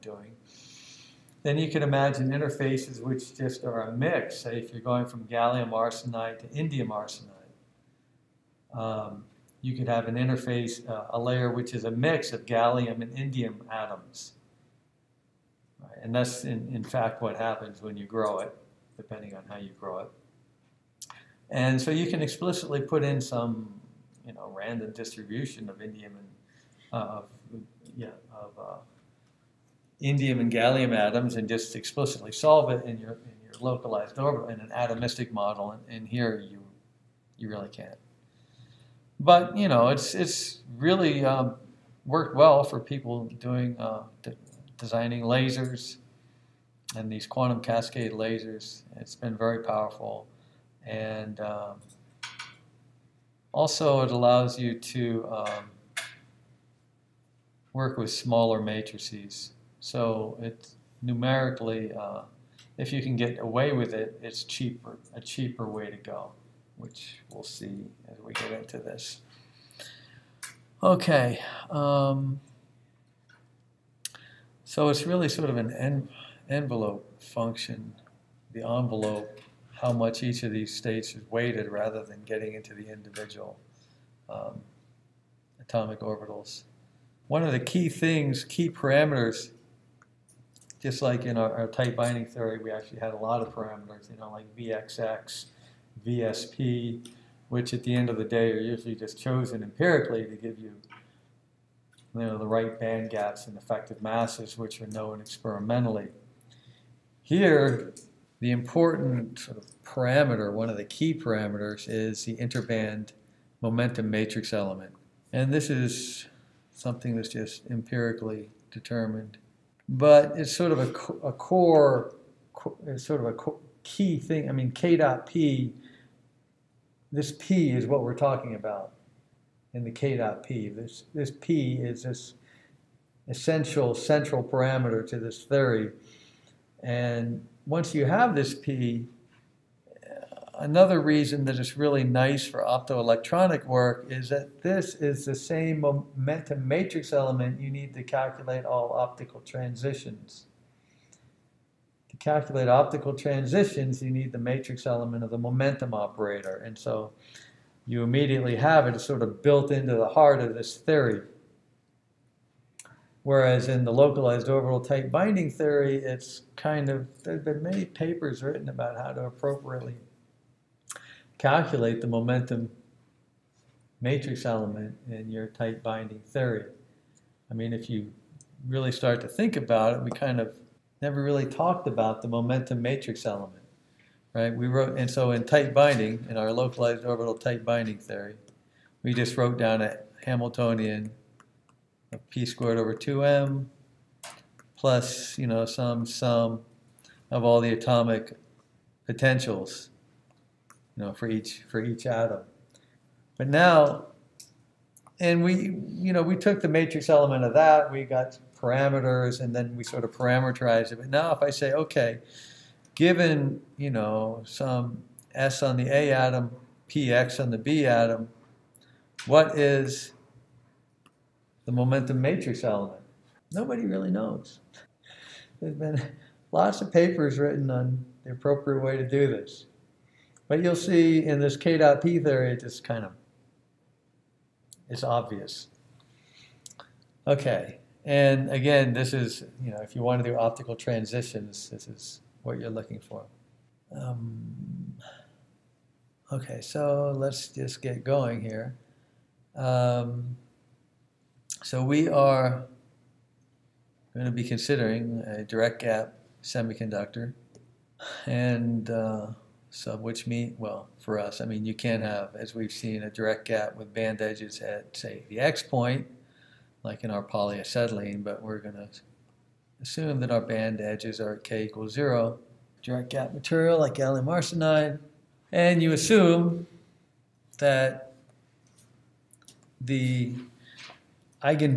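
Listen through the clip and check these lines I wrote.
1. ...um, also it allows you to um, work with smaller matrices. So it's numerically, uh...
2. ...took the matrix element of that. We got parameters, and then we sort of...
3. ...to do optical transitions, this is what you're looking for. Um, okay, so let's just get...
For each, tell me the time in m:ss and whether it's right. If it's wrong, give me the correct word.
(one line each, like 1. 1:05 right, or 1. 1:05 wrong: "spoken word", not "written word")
1. 0:51 right
2. 3:26 right
3. 4:00 right.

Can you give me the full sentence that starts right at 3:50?
But you'll see in this K dot P theory, it just kind of it's obvious.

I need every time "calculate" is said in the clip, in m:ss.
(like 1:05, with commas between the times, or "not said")
2:28, 2:32, 2:51.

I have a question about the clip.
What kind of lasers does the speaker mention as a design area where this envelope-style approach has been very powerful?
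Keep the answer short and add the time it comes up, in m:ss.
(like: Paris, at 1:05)
Quantum cascade lasers, at 0:47.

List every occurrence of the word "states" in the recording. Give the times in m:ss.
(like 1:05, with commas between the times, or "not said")
1:20.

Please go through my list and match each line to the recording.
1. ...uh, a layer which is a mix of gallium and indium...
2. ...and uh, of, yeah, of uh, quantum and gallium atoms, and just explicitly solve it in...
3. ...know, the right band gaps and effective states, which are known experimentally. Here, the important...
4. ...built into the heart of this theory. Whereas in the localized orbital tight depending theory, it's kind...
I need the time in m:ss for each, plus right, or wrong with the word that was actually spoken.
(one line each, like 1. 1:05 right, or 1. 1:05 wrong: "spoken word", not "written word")
1. 0:10 right
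2. 0:26 wrong: "indium", not "quantum"
3. 1:42 wrong: "masses", not "states"
4. 2:39 wrong: "binding", not "depending".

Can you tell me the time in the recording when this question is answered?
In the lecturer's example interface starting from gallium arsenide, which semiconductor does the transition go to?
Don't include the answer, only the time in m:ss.
0:06.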